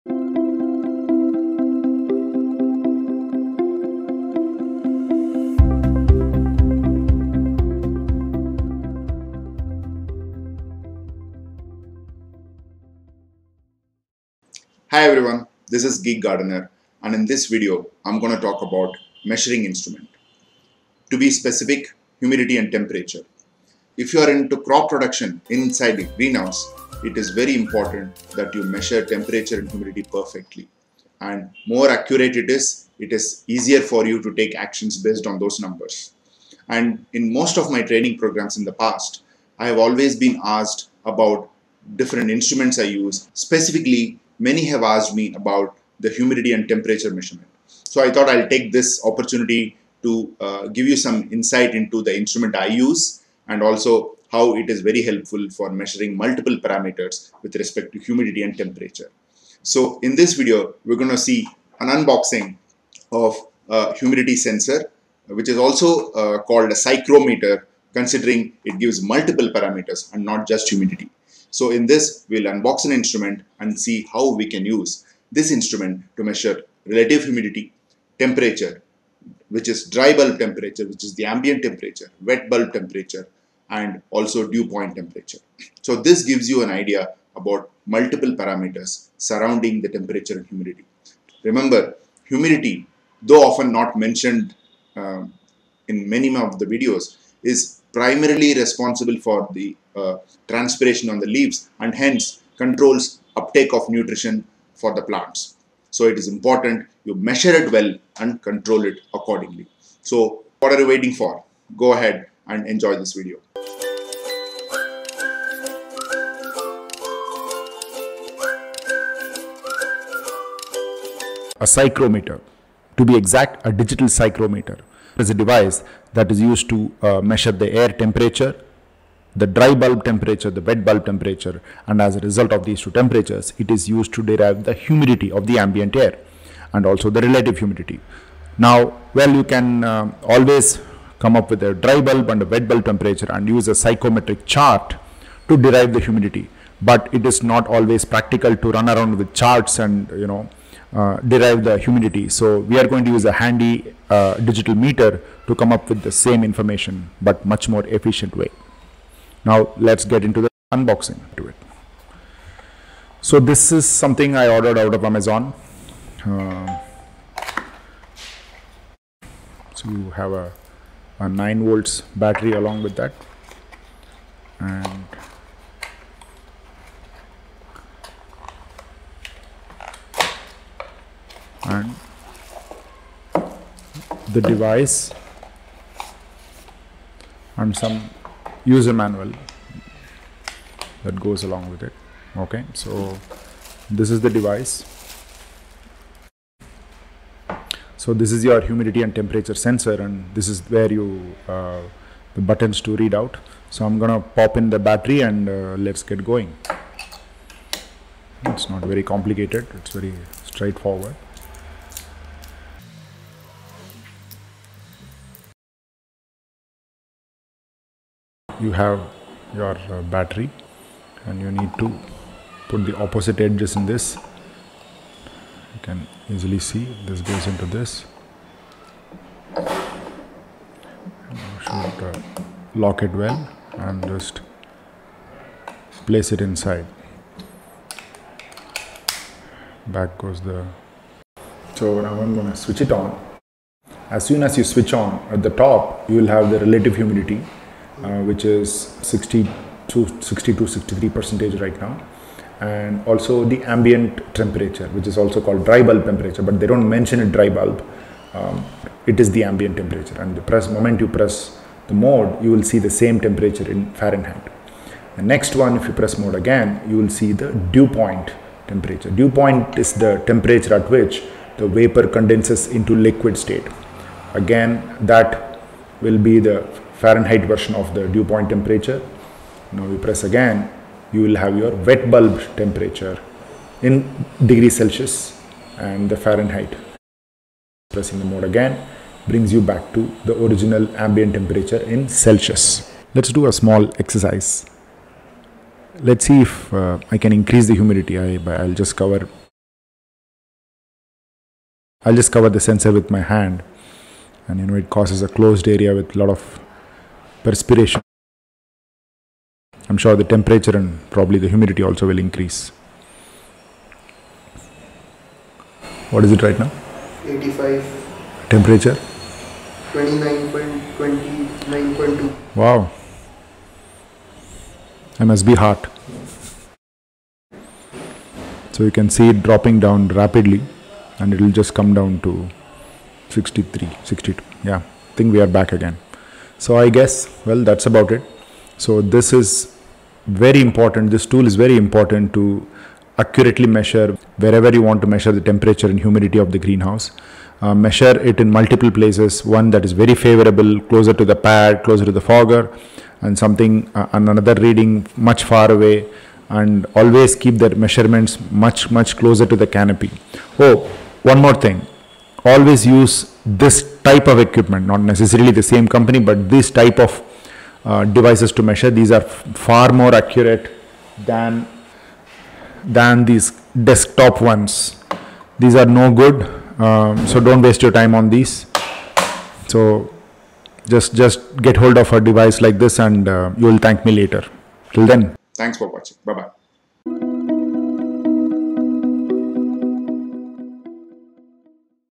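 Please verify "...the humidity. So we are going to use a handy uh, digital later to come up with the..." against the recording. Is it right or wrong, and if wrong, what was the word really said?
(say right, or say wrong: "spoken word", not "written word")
wrong: "meter", not "later".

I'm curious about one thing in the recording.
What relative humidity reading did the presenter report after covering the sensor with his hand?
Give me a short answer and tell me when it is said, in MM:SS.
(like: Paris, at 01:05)
85, at 05:17.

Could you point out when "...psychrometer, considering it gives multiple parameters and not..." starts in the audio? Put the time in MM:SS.
01:06.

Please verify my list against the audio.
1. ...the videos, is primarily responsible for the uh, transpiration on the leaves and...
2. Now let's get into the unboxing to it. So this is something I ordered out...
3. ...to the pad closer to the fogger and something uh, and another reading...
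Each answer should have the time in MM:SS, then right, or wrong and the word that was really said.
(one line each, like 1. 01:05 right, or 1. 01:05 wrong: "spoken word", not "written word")
1. 01:36 right
2. 02:39 right
3. 05:51 right.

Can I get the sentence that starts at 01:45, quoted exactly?
So it is important you measure it well and control it accordingly.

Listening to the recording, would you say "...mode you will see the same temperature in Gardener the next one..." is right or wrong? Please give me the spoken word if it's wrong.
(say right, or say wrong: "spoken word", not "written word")
wrong: "Fahrenheit", not "Gardener".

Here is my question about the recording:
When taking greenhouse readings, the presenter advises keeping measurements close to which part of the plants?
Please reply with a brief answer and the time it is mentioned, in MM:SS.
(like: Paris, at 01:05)
the canopy, at 05:59.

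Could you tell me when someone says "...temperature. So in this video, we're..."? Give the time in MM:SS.
00:58.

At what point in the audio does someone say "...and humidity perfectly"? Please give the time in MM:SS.
00:29.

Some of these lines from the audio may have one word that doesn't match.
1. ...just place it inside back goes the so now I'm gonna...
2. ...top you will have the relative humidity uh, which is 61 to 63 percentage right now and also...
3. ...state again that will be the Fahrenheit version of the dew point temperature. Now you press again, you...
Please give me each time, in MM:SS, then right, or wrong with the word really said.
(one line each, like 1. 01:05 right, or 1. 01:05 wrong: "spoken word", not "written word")
1. 03:54 right
2. 04:05 wrong: "60", not "61"
3. 04:33 right.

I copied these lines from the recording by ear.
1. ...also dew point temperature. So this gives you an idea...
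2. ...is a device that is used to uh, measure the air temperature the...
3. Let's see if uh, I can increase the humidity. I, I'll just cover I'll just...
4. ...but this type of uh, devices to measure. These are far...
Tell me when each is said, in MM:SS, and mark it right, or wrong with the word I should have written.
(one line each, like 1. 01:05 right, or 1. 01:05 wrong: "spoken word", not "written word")
1. 01:24 right
2. 02:05 right
3. 04:55 right
4. 06:06 right.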